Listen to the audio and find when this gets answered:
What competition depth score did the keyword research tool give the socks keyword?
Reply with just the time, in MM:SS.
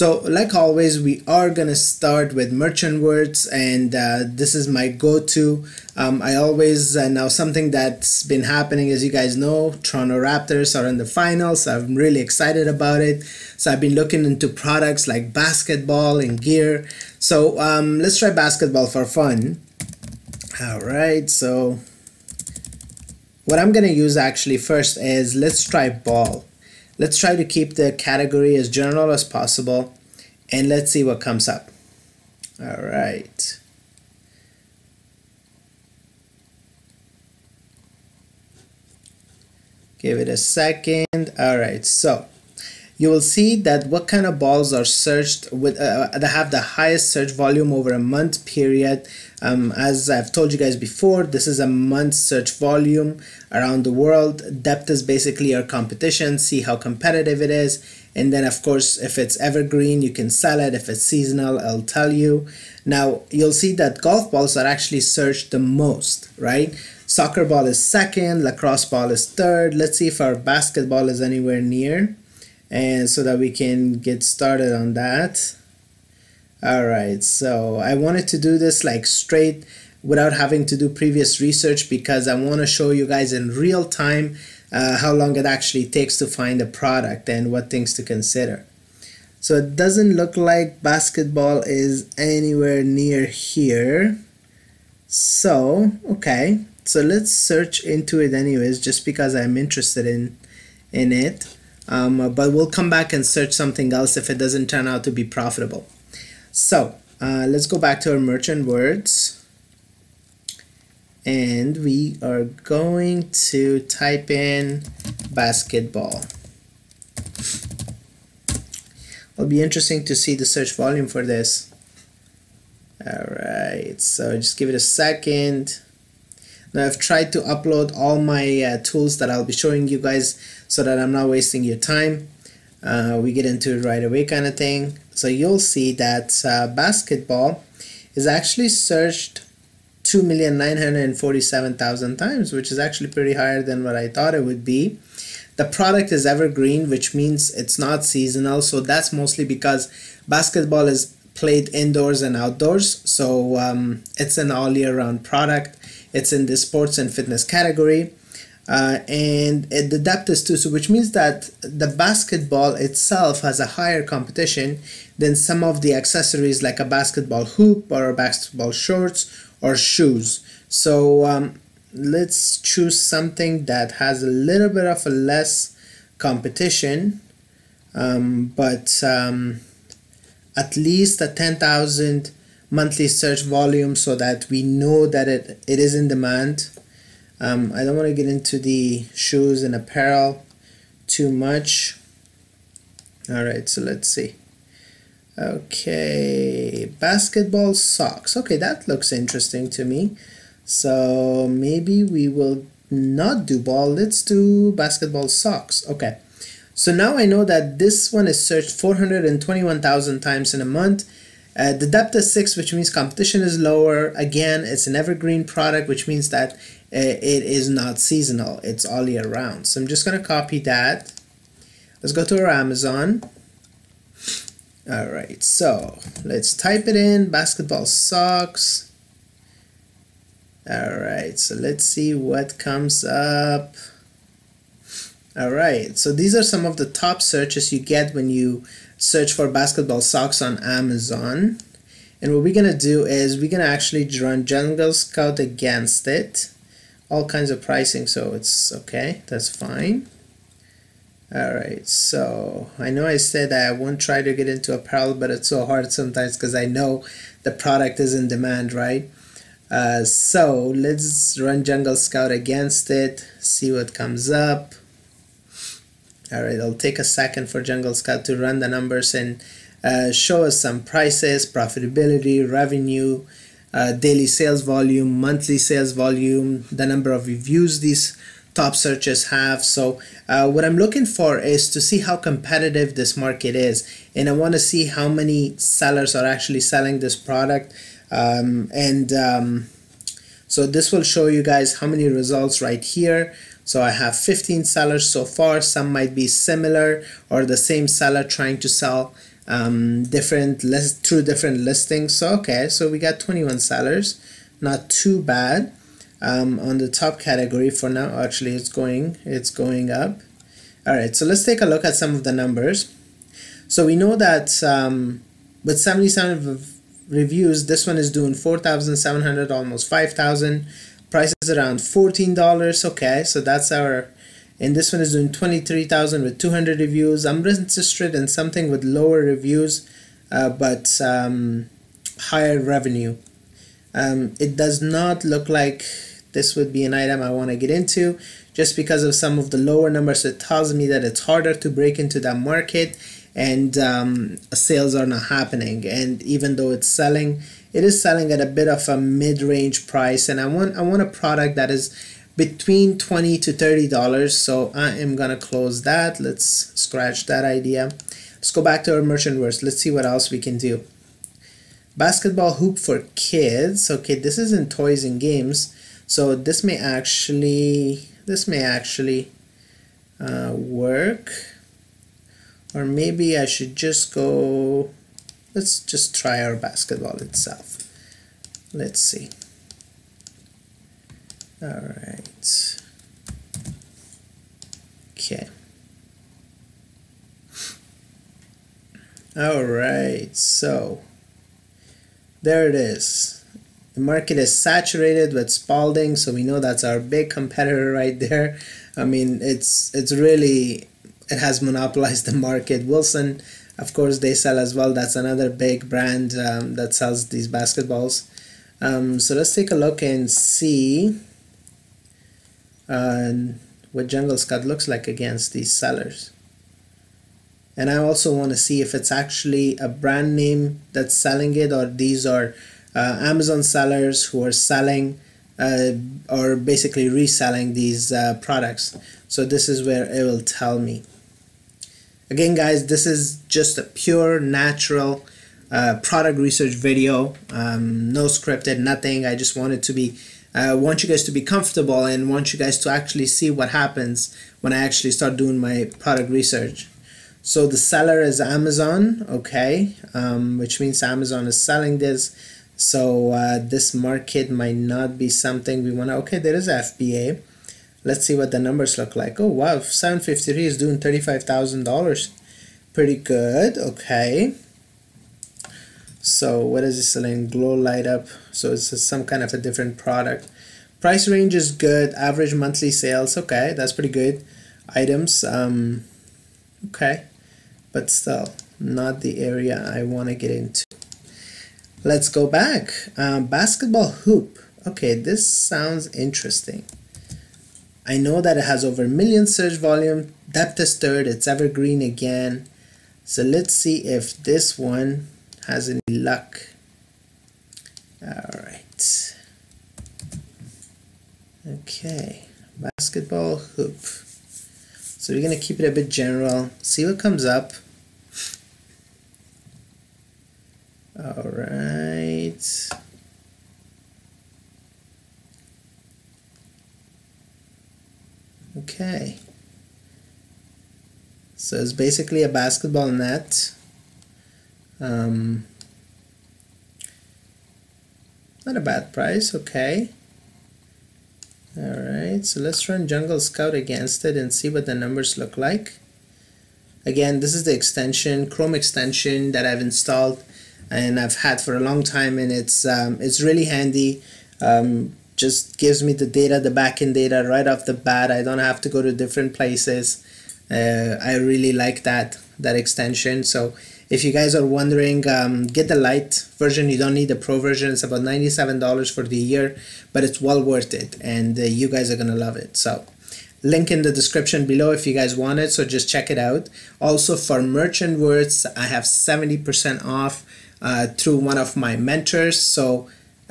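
03:32.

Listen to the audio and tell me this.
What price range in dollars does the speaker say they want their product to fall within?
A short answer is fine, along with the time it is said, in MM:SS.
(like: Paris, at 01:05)
$20 to $30, at 05:52.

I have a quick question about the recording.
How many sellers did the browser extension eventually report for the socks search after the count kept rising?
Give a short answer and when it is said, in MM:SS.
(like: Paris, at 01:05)
21, at 05:03.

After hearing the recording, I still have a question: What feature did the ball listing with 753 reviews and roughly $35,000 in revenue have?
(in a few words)
glow light up.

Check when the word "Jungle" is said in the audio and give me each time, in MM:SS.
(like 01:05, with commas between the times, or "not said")
04:04, 04:21, 04:27, 06:54, 08:53.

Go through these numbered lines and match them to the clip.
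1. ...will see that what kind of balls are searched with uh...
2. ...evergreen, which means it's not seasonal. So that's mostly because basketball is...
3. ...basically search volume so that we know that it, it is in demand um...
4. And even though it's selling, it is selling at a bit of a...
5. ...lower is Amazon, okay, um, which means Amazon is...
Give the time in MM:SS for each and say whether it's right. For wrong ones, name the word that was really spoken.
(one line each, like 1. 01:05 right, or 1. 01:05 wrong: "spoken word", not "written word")
1. 00:43 right
2. 02:26 right
3. 03:02 wrong: "monthly", not "basically"
4. 05:45 right
5. 07:27 wrong: "seller", not "lower".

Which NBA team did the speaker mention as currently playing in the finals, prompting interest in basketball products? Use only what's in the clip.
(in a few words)
Toronto Raptors.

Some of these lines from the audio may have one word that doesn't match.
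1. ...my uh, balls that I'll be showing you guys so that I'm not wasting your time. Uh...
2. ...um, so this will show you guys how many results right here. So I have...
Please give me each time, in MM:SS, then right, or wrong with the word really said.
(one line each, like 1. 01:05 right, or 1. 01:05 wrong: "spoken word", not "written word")
1. 02:08 wrong: "tools", not "balls"
2. 04:49 right.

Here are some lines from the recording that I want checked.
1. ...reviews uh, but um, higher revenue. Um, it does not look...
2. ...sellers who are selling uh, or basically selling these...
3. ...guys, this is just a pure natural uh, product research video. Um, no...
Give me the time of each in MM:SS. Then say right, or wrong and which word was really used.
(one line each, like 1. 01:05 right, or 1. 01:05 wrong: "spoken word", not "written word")
1. 05:29 right
2. 07:03 wrong: "reselling", not "selling"
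3. 07:12 right.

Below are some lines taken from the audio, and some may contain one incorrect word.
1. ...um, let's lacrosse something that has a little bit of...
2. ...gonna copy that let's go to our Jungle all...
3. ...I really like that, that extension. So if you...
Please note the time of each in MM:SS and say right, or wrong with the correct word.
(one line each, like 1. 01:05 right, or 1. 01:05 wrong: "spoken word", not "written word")
1. 02:51 wrong: "choose", not "lacrosse"
2. 03:40 wrong: "Amazon", not "Jungle"
3. 09:11 right.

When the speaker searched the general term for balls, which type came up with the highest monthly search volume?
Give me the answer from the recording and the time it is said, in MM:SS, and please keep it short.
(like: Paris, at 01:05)
golf balls, at 01:04.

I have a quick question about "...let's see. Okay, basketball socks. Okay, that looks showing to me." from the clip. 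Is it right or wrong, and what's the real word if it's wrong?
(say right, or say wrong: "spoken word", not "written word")
wrong: "interesting", not "showing".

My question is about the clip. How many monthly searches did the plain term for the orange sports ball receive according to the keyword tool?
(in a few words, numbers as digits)
2,947,000.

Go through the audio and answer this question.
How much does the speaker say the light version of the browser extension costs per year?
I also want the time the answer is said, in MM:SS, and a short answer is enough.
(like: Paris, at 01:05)
$97, at 09:18.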